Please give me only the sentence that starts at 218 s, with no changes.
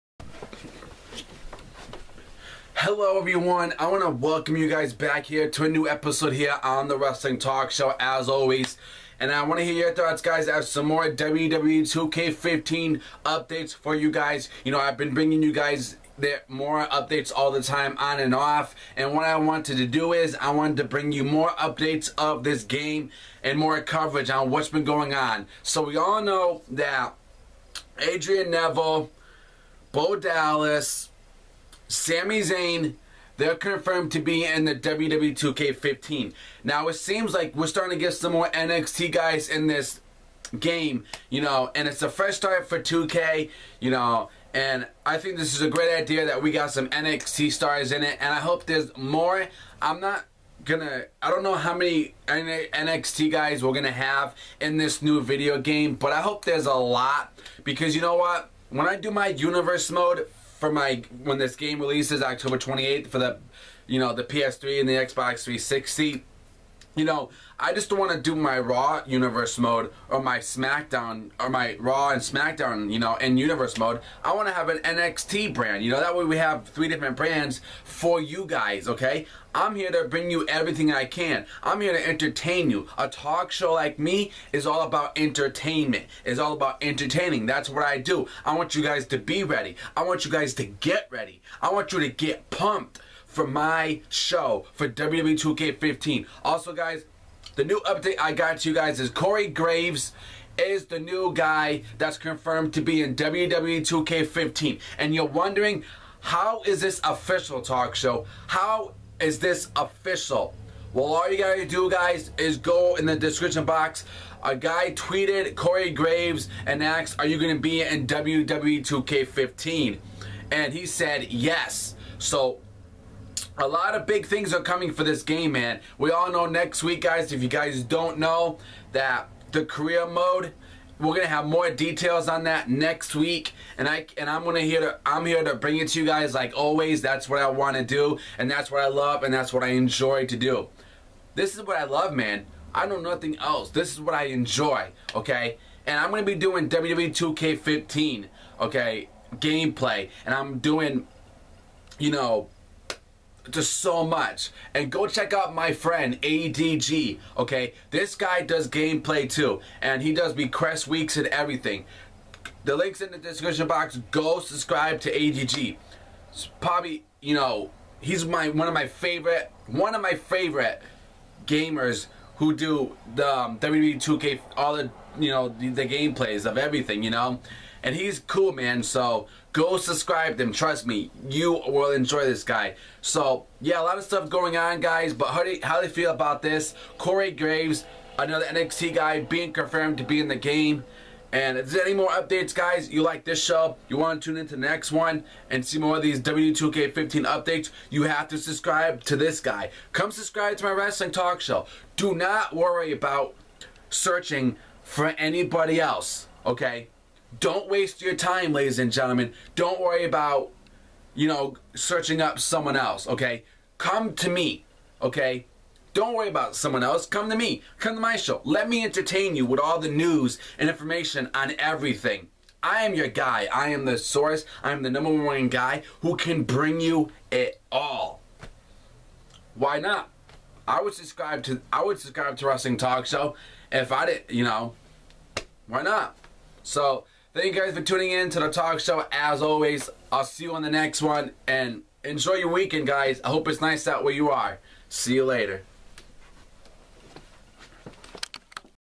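Let me entertain you with all the news and information on everything.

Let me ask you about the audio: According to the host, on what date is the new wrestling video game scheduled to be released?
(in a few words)
October 28th.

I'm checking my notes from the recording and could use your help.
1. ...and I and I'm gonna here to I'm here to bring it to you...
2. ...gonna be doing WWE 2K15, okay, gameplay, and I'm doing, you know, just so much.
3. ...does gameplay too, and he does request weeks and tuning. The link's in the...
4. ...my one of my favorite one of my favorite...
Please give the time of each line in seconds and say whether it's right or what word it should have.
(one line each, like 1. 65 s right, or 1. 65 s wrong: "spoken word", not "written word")
1. 133 s right
2. 146 s right
3. 158 s wrong: "everything", not "tuning"
4. 168 s right.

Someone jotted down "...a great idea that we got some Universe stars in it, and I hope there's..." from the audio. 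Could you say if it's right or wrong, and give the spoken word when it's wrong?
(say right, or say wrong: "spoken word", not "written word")
wrong: "NXT", not "Universe".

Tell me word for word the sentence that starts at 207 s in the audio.
Don't waste your time, ladies and gentlemen.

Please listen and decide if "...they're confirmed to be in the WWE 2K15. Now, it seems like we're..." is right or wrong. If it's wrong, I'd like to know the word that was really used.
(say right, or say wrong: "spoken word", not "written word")
right.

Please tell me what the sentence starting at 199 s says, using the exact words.
Come subscribe to my wrestling talk show.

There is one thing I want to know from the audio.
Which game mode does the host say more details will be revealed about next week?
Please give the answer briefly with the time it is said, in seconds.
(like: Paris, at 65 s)
Career mode, at 129 s.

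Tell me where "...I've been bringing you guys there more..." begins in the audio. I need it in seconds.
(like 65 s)
14 s.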